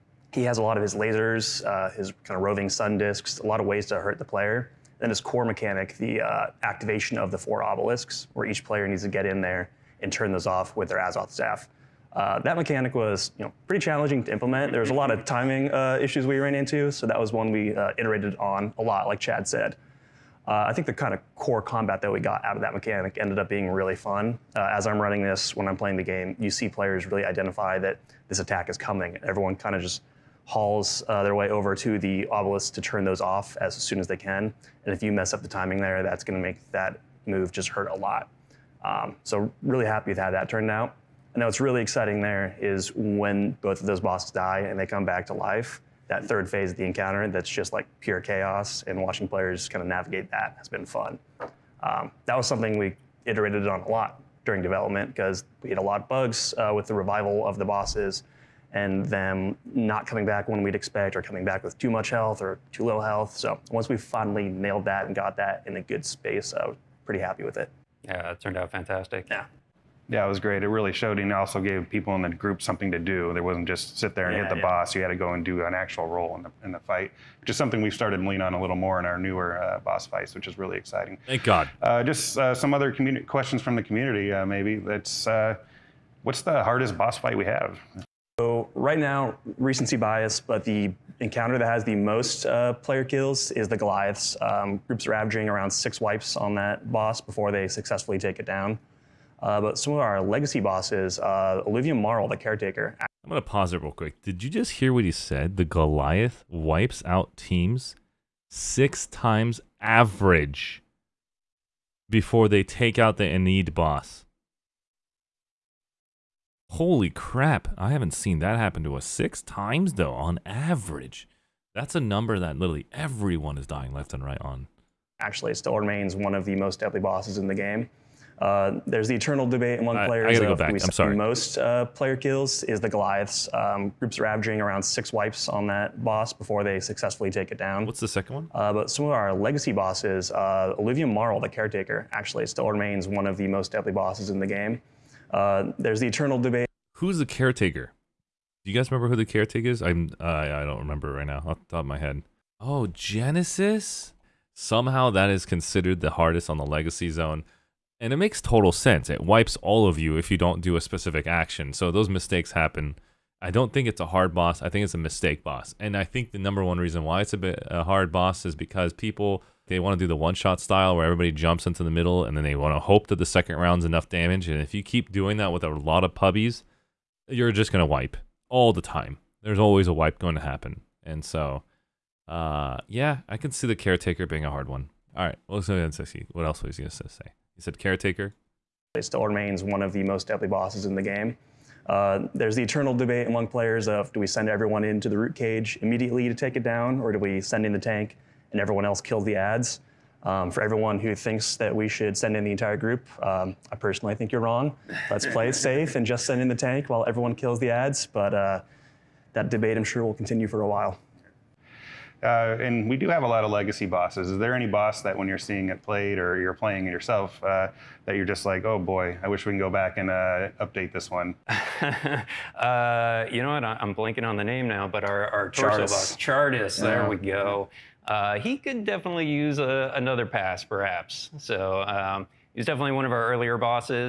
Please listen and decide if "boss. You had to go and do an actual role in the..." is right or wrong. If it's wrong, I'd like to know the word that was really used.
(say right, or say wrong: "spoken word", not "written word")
right.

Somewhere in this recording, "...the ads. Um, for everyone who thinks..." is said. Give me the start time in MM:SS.
03:19.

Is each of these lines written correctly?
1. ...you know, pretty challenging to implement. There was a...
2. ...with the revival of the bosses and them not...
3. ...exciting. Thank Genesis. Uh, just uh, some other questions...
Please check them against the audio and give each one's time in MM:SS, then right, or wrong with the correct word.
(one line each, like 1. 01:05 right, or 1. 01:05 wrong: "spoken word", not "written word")
1. 00:13 right
2. 00:56 right
3. 01:20 wrong: "God", not "Genesis".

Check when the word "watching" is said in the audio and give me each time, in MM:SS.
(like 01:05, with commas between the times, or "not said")
00:49.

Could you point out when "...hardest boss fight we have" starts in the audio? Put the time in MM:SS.
01:26.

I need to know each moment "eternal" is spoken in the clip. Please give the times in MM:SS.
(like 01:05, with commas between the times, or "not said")
02:09, 02:26, 03:12.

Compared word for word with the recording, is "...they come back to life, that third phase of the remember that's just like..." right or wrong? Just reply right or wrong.
wrong.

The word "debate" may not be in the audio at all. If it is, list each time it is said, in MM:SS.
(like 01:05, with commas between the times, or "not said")
02:09, 02:26, 03:12, 03:29.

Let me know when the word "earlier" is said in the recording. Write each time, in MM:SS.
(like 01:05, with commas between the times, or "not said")
03:53.